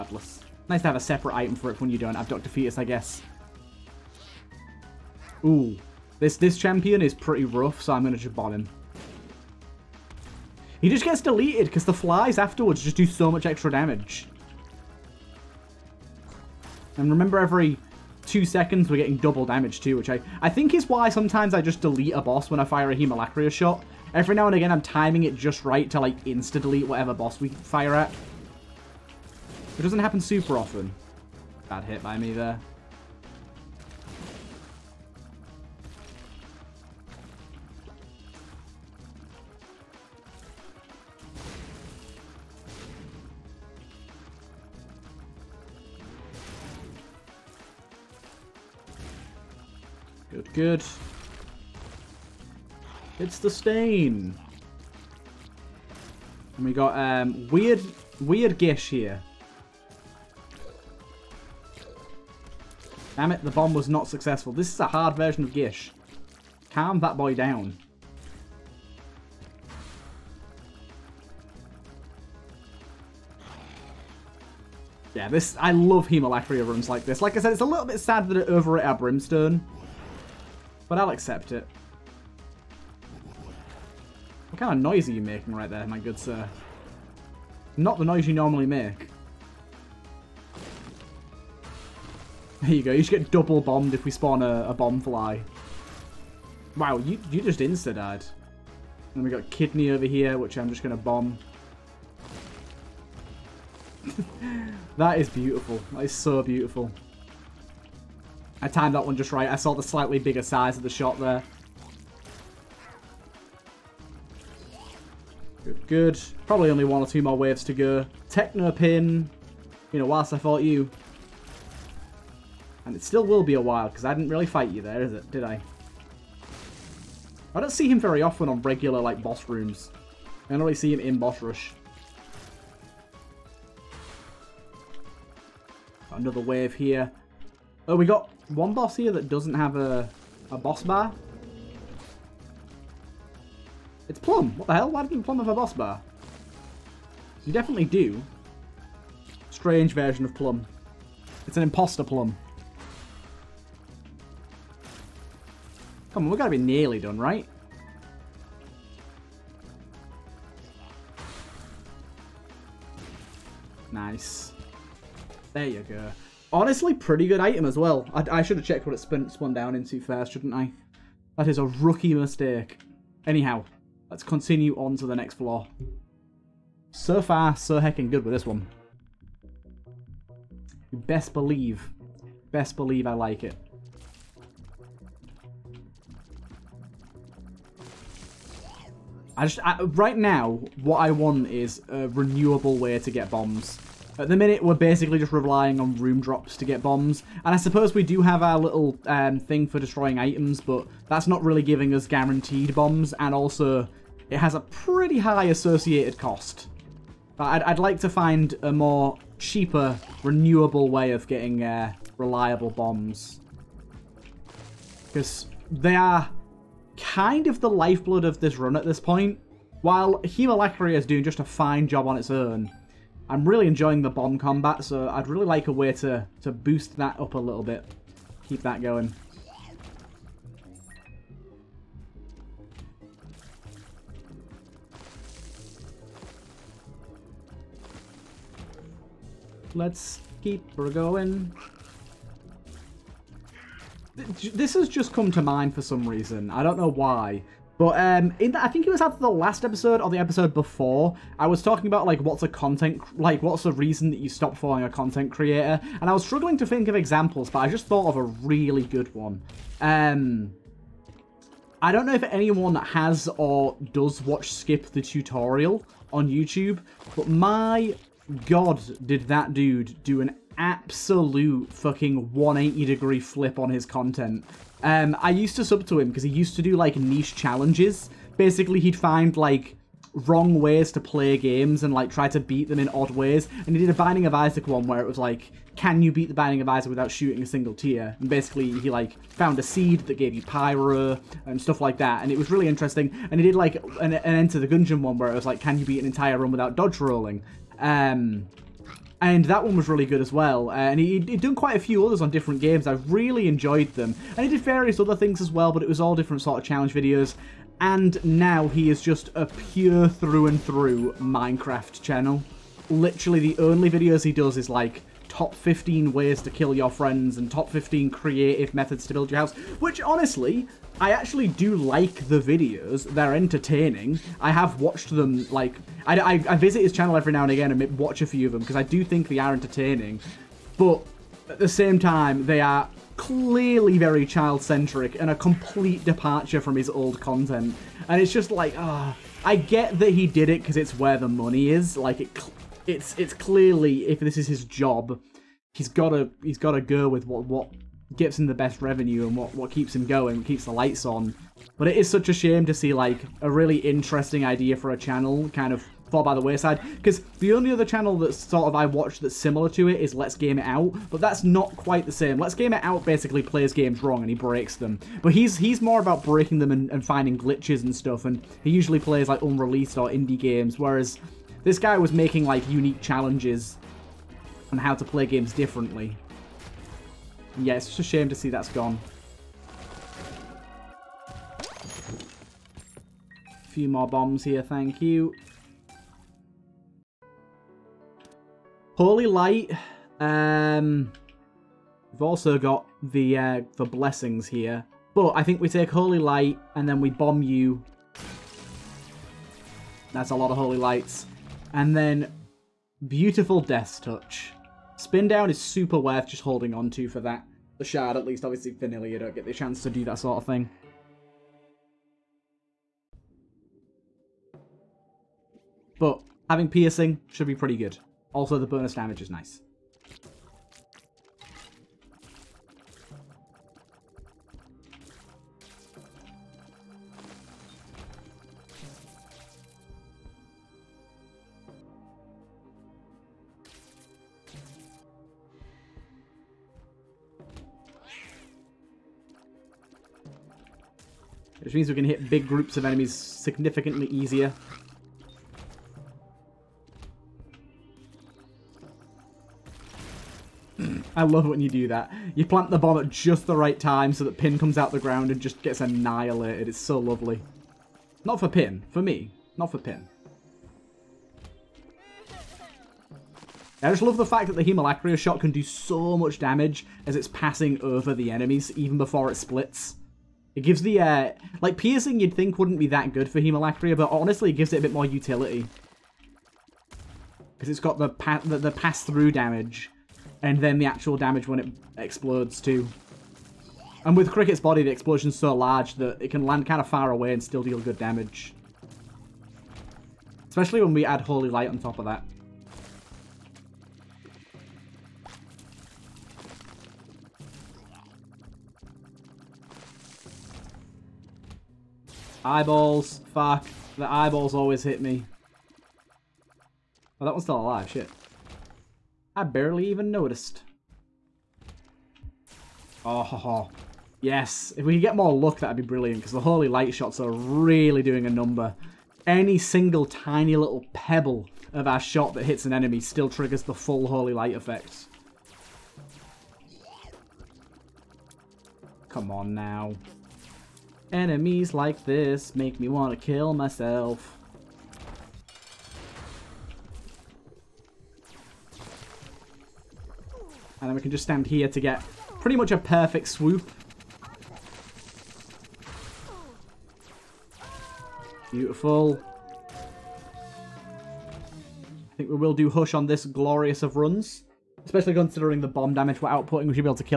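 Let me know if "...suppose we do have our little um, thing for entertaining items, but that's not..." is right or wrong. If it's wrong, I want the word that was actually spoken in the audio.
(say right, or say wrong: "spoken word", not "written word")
wrong: "destroying", not "entertaining".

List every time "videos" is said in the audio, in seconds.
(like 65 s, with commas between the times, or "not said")
306 s, 313 s, 322 s.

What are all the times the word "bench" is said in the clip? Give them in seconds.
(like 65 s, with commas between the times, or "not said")
not said.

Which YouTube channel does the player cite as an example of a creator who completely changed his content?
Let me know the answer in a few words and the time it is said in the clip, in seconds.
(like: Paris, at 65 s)
Skip the Tutorial, at 264 s.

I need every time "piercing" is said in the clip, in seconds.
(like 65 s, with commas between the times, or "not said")
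416 s, 471 s.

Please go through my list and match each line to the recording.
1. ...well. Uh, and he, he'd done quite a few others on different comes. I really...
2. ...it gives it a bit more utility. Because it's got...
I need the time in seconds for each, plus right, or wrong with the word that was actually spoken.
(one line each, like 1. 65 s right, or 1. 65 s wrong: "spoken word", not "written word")
1. 300 s wrong: "games", not "comes"
2. 474 s right.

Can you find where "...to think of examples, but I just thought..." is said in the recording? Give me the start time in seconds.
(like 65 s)
256 s.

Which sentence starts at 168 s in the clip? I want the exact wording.
I, I should have checked what it spun, spun down into first, shouldn't I?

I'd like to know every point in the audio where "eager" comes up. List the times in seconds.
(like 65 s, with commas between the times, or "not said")
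not said.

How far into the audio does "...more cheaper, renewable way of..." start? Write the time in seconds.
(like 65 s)
208 s.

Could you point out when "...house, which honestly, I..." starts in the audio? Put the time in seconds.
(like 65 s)
319 s.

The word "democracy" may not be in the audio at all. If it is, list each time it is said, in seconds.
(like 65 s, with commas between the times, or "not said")
not said.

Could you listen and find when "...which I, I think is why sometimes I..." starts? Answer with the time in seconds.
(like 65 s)
19 s.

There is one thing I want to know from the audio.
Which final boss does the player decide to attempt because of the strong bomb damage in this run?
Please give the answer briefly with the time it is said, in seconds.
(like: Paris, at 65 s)
Hush, at 552 s.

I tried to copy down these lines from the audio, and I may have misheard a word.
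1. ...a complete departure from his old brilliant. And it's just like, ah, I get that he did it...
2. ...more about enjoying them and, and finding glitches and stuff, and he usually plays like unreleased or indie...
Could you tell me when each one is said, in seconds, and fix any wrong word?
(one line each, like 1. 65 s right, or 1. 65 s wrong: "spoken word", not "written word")
1. 335 s wrong: "content", not "brilliant"
2. 365 s wrong: "breaking", not "enjoying".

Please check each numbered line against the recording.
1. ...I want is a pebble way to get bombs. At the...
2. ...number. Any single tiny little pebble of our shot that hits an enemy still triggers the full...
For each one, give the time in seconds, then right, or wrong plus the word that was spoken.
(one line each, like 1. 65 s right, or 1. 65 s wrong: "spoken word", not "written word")
1. 190 s wrong: "renewable", not "pebble"
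2. 518 s right.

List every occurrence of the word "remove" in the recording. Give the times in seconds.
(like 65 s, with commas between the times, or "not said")
not said.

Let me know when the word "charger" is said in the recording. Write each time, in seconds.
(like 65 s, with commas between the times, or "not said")
not said.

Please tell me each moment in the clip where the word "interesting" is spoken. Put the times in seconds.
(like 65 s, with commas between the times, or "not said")
292 s, 353 s.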